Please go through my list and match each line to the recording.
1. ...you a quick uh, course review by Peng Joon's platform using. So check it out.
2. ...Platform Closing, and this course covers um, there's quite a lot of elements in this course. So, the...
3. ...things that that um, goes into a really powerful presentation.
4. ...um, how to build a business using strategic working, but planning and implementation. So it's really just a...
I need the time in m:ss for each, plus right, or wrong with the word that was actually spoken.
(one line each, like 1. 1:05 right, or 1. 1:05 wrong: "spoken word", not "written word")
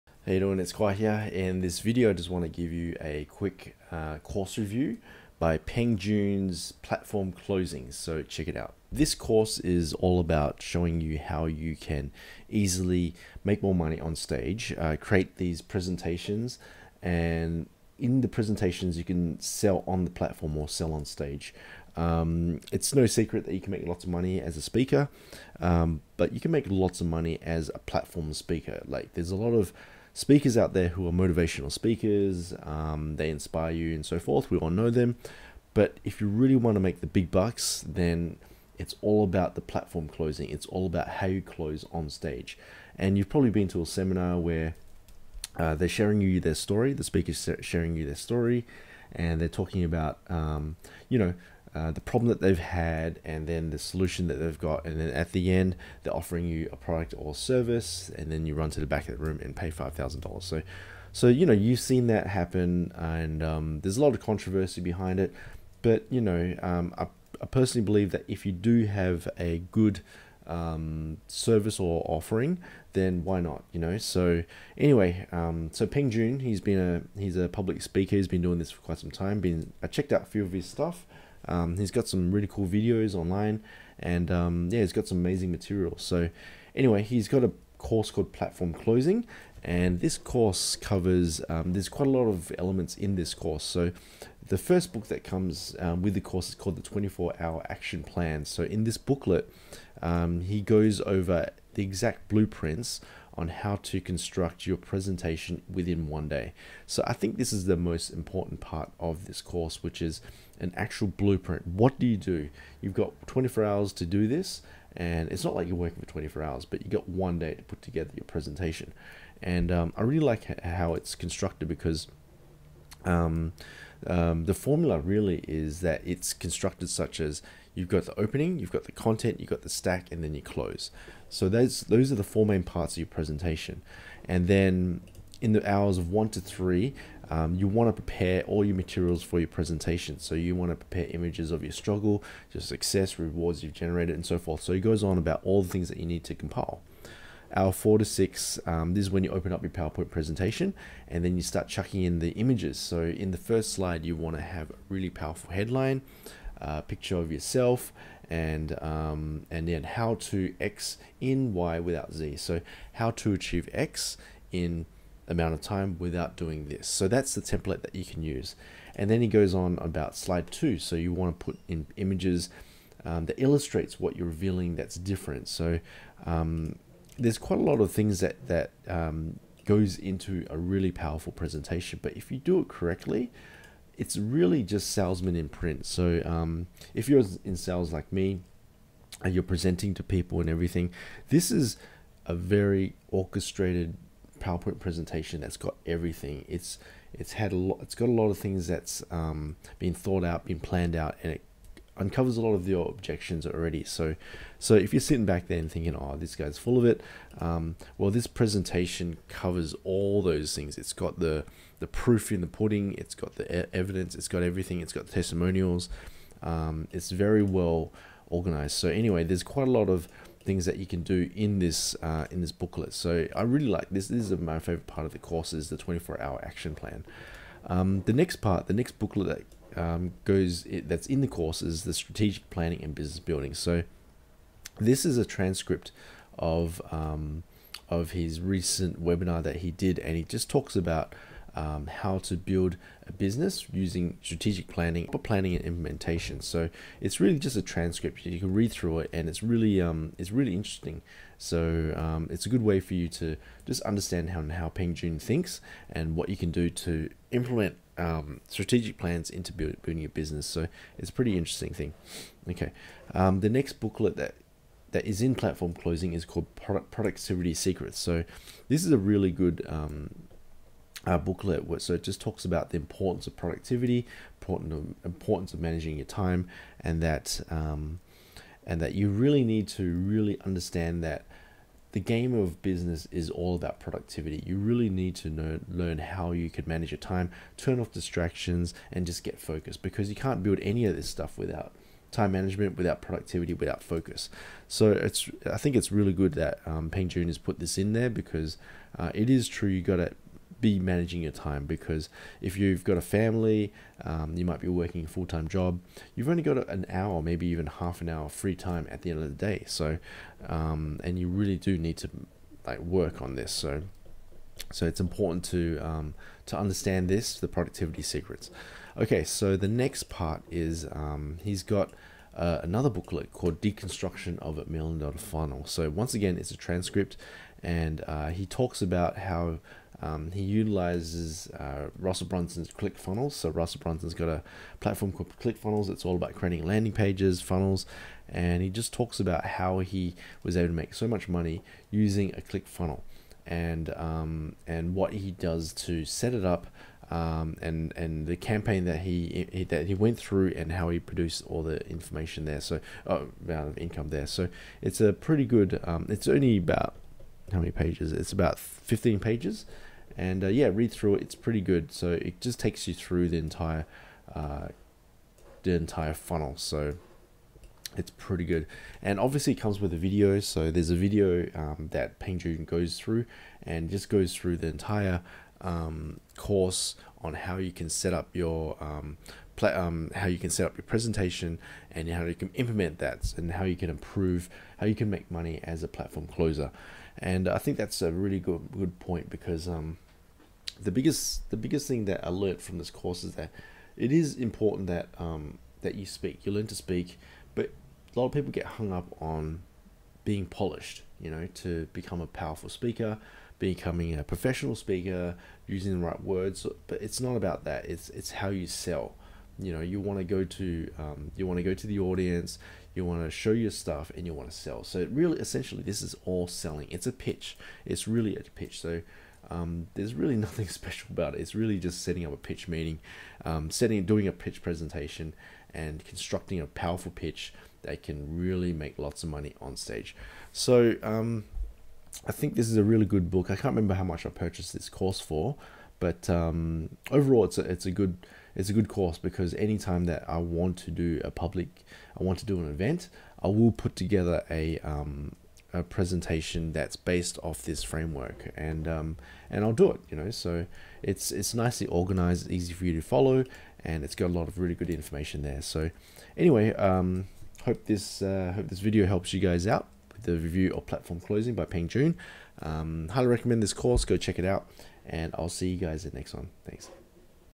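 1. 0:02 wrong: "closing", not "using"
2. 1:28 right
3. 2:57 right
4. 4:01 wrong: "planning", not "working".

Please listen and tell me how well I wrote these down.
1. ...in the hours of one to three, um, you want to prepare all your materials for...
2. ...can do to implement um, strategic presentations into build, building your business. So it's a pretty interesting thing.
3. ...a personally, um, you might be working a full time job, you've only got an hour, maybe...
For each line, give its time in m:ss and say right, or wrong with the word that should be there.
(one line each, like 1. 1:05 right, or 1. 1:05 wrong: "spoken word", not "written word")
1. 2:15 right
2. 4:16 wrong: "plans", not "presentations"
3. 5:02 wrong: "family", not "personally".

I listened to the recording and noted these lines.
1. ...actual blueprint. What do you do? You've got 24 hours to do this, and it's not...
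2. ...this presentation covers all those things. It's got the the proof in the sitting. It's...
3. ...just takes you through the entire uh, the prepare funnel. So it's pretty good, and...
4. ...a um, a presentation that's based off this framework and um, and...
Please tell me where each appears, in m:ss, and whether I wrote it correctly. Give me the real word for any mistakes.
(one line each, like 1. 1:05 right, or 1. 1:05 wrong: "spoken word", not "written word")
1. 1:50 right
2. 3:28 wrong: "pudding", not "sitting"
3. 6:02 wrong: "entire", not "prepare"
4. 7:24 right.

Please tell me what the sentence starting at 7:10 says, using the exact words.
So um, I think this is a really good book.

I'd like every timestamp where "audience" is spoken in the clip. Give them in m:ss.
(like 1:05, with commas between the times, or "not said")
6:51.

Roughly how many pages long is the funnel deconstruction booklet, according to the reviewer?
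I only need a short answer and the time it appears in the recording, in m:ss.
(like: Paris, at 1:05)
15, at 5:58.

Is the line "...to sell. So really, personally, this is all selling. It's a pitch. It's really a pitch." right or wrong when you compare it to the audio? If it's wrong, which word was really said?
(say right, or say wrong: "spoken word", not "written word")
wrong: "essentially", not "personally".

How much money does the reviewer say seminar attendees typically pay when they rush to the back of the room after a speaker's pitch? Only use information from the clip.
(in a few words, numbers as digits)
$5000.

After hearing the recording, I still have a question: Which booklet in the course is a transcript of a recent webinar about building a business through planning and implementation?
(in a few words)
Strategic Planning and Business Building.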